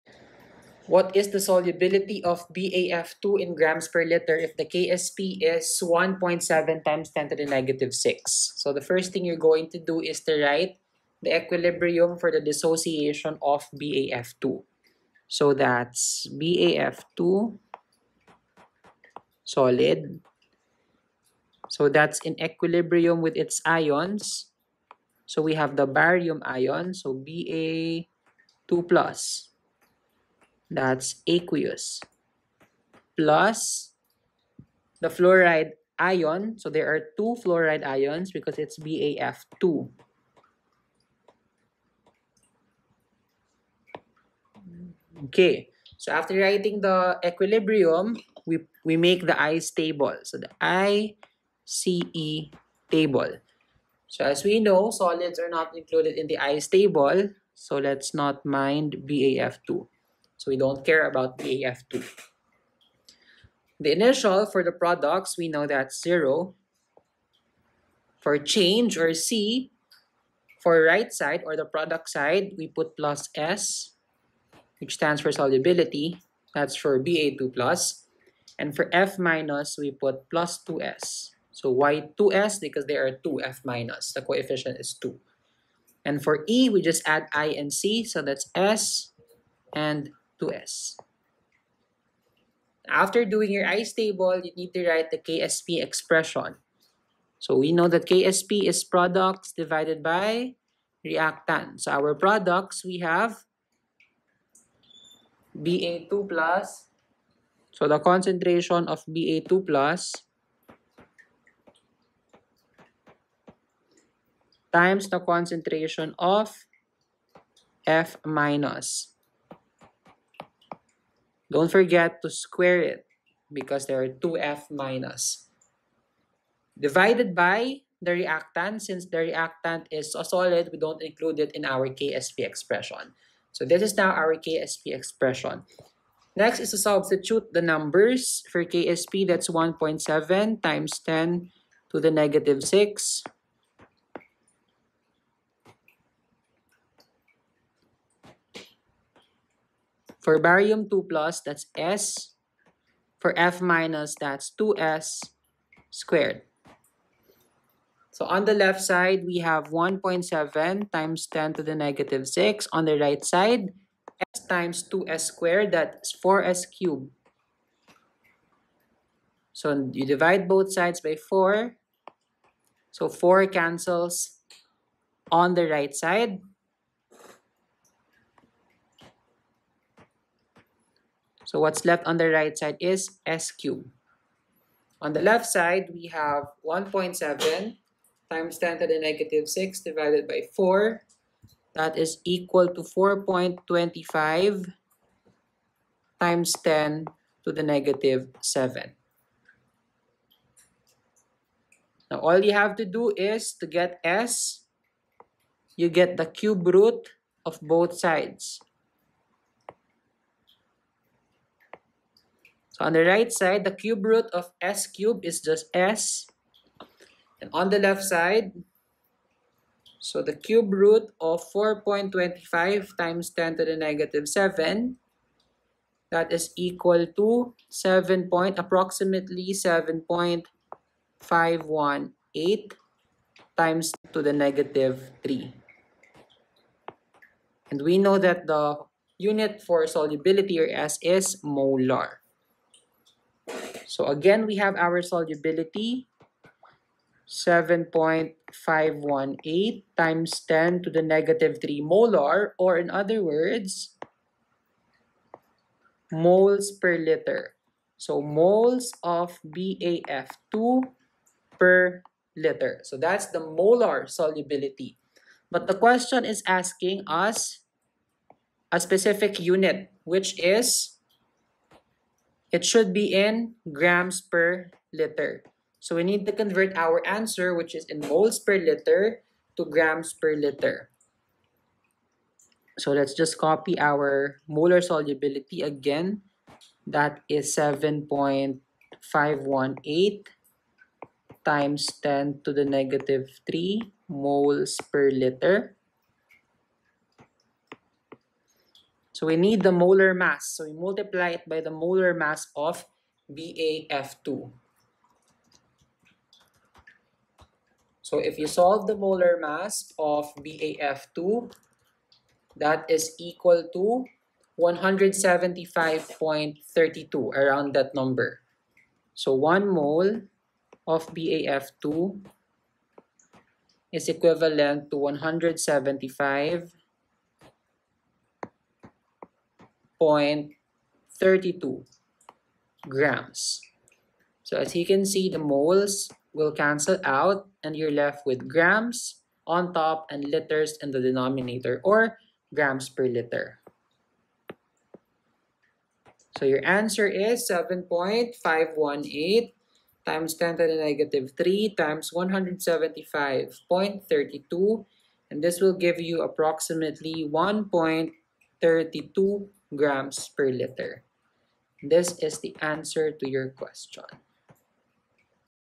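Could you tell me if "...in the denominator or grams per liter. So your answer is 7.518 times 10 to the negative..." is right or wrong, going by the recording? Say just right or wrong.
right.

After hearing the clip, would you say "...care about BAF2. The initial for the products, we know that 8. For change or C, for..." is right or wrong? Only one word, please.
wrong.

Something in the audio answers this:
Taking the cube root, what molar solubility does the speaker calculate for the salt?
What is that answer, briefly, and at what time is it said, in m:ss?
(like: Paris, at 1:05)
7.518 × 10^-3 M, at 3:49.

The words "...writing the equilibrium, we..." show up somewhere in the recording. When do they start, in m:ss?
0:46.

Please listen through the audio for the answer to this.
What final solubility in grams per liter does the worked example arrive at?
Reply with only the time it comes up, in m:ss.
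5:57.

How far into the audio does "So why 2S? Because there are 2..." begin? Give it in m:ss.
1:21.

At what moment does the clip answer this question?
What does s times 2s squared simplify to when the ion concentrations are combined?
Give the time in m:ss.
2:46.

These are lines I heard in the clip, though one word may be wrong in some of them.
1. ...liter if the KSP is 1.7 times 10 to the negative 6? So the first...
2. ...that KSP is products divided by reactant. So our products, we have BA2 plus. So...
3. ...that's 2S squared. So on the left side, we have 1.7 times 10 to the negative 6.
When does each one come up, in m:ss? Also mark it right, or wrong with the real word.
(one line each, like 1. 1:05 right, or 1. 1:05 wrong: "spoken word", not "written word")
1. 0:04 right
2. 1:37 right
3. 2:34 right.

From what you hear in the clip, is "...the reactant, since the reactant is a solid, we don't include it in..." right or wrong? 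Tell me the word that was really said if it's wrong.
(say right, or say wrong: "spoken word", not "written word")
right.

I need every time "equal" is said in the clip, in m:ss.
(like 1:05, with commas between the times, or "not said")
3:12, 3:46, 5:13.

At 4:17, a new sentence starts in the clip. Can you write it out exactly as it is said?
So moles of BAF2 per liter.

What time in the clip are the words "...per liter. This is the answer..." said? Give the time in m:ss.
6:00.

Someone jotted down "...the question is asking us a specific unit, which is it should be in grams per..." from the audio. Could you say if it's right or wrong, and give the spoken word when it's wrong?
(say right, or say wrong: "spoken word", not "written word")
right.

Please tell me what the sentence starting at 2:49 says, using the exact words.
So you divide both sides by 4.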